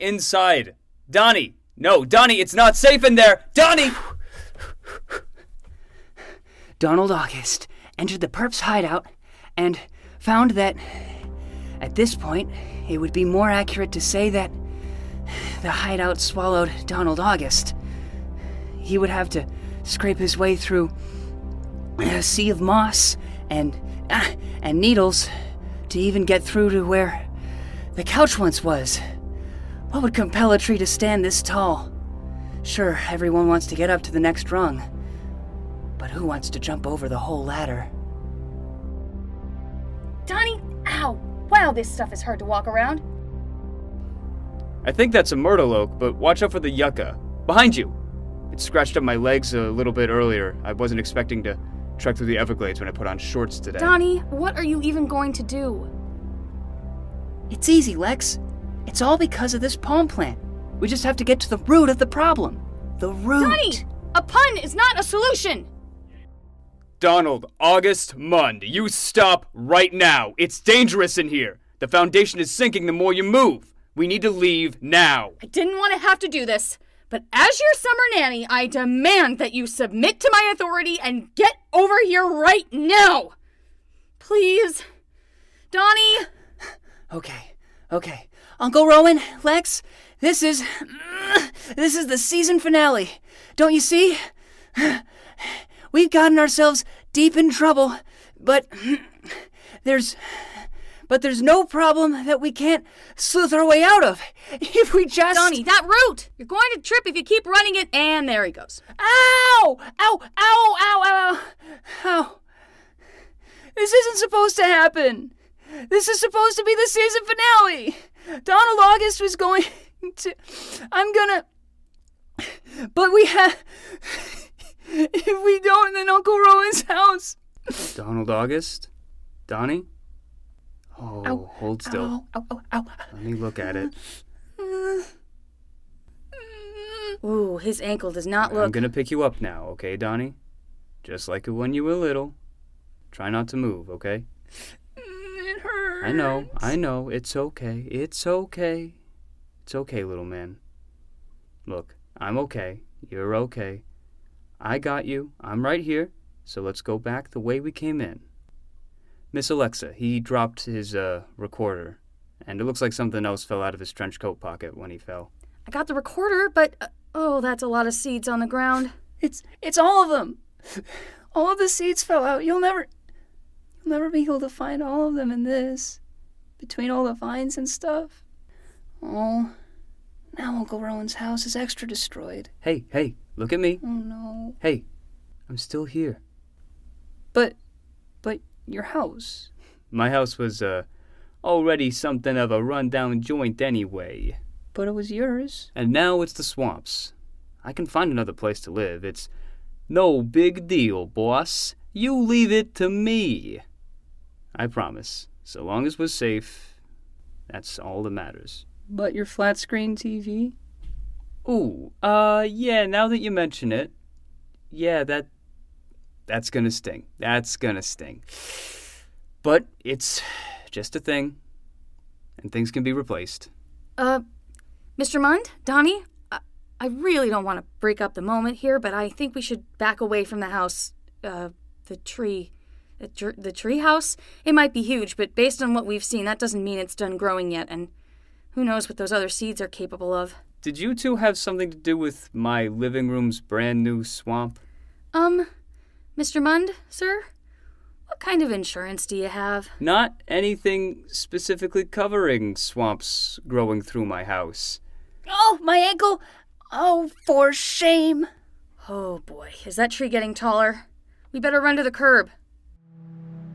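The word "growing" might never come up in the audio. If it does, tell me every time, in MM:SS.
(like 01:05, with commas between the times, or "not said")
03:57, 04:13.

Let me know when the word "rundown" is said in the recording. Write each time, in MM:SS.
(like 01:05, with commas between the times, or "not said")
03:12.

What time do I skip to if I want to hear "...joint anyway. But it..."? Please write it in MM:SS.
03:13.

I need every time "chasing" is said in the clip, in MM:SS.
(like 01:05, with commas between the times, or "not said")
not said.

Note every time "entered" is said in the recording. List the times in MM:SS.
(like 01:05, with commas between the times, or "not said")
00:07.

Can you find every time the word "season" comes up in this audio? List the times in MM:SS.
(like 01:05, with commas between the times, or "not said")
01:32, 01:56.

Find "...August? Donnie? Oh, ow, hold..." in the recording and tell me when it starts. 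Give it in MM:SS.
02:08.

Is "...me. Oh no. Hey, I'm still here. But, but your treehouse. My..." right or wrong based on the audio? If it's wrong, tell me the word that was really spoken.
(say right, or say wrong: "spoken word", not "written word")
wrong: "house", not "treehouse".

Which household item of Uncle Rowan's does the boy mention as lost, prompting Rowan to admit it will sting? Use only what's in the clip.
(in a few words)
Flat screen TV.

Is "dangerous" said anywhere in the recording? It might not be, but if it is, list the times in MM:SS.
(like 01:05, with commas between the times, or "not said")
01:10.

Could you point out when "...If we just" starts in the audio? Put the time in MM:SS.
01:44.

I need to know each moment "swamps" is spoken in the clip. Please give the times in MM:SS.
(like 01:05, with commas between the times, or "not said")
03:16, 04:04, 04:12.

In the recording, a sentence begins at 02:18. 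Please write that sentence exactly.
I'm gonna pick you up now, okay, Donnie?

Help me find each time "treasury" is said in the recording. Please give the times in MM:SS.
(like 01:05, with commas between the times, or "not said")
not said.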